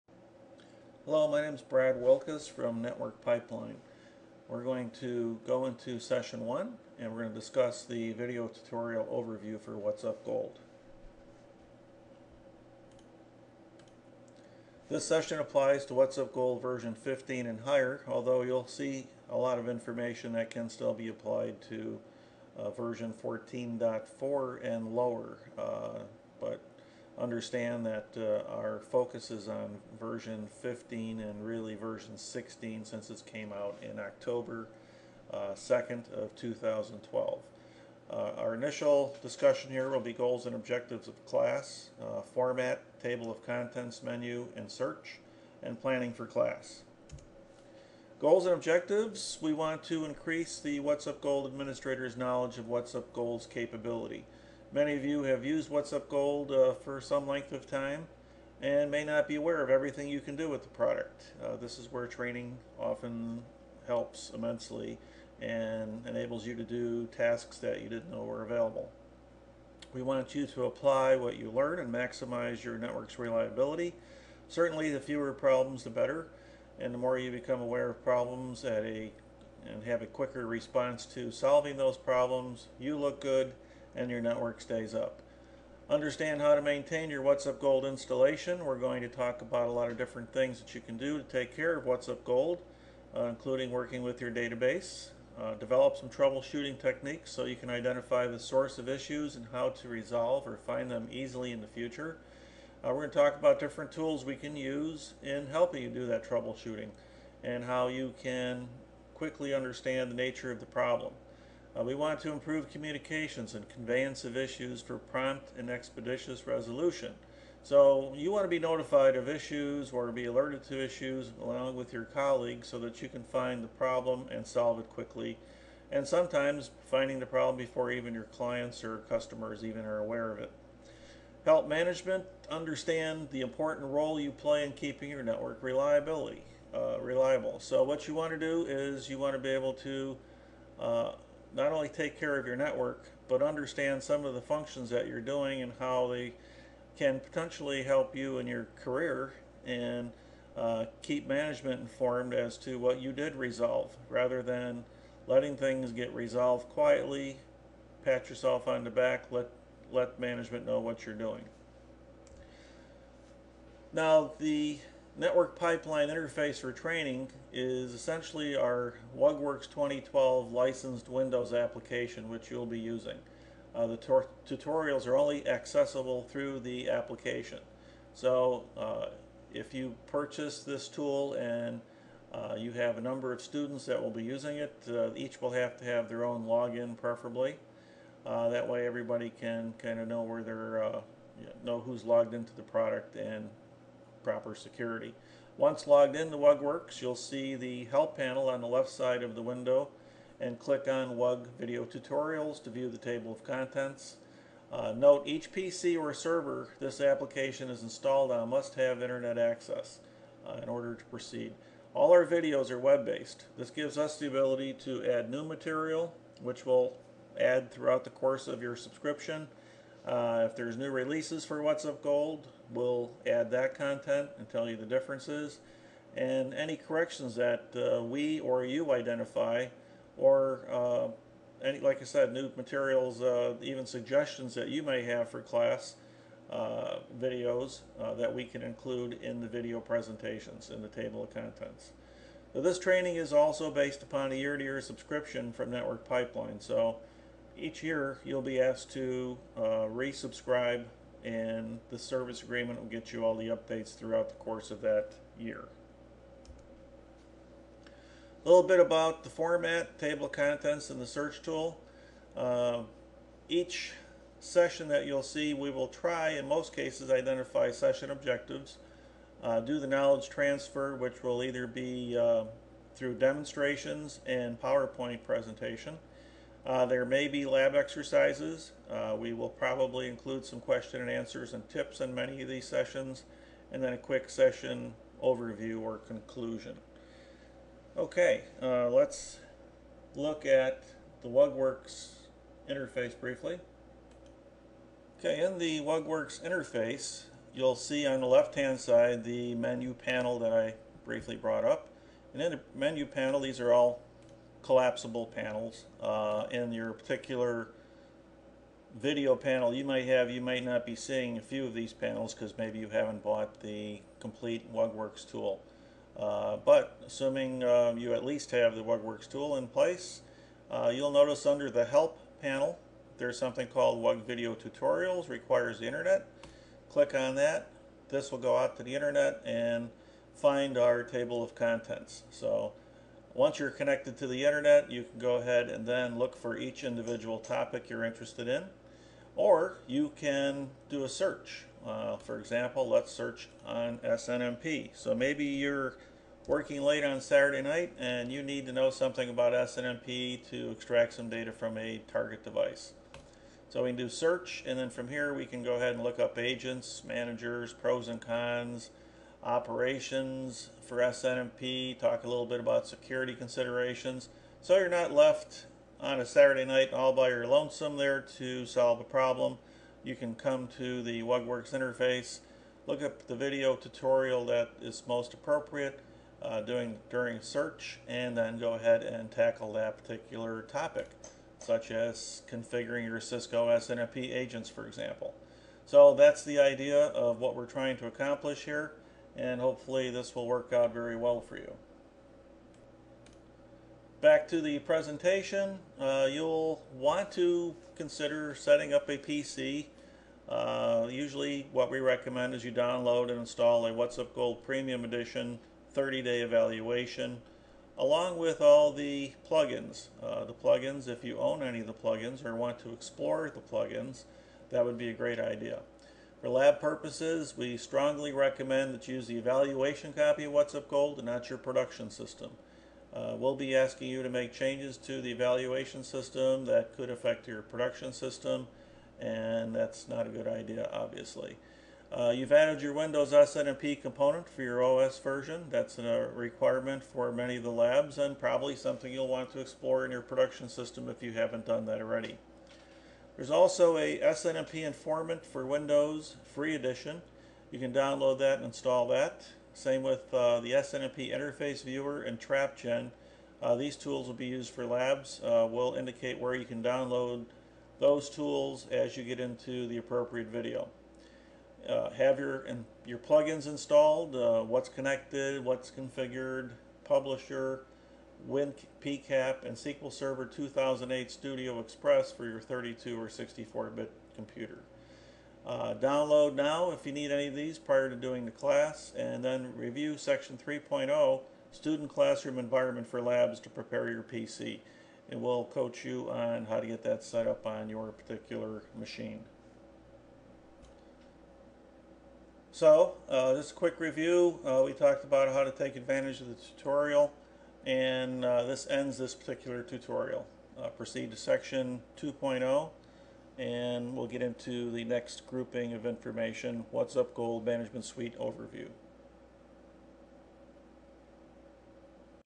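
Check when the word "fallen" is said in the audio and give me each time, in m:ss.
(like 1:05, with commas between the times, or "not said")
not said.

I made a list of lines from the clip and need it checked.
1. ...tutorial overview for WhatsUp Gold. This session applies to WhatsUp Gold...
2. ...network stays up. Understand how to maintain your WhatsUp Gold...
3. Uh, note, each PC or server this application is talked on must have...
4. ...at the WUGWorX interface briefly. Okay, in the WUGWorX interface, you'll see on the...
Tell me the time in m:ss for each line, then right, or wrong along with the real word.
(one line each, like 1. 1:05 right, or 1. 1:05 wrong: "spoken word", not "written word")
1. 0:08 right
2. 1:24 right
3. 3:24 wrong: "installed", not "talked"
4. 4:50 right.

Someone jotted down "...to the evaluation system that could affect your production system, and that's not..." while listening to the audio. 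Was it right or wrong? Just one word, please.
right.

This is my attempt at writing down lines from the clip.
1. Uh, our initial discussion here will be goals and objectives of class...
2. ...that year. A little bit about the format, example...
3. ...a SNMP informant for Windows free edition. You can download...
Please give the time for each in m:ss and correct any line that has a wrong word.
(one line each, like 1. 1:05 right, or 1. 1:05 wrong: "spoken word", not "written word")
1. 0:38 right
2. 4:14 wrong: "table", not "example"
3. 7:23 right.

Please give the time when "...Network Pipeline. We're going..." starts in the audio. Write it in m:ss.
0:02.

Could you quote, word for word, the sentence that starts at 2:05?
And sometimes finding the problem before even your clients or customers even are aware of it.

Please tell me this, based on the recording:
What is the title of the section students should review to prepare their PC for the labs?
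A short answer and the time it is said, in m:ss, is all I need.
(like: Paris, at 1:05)
Student Classroom Environment for Labs, at 8:01.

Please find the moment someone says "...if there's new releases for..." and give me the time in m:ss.
3:40.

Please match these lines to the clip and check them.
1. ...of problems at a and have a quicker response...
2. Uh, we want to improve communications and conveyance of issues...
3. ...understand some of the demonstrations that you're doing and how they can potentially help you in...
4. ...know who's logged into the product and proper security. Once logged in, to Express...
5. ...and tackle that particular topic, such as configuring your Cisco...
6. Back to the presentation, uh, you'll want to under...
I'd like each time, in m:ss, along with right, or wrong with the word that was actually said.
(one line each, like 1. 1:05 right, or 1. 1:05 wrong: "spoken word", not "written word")
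1. 1:17 right
2. 1:51 right
3. 2:23 wrong: "functions", not "demonstrations"
4. 3:11 wrong: "WUGWorX", not "Express"
5. 6:19 right
6. 6:34 wrong: "consider", not "under".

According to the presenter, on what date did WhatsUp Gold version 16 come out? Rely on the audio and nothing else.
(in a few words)
October 2, 2012.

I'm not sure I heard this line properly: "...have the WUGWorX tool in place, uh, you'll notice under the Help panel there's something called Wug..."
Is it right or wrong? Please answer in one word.
right.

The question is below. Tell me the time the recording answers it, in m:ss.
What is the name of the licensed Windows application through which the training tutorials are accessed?
2:49.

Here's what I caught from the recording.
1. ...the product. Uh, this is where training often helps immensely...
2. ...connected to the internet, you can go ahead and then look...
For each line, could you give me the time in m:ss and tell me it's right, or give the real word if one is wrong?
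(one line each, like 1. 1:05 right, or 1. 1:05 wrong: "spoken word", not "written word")
1. 1:00 right
2. 5:33 right.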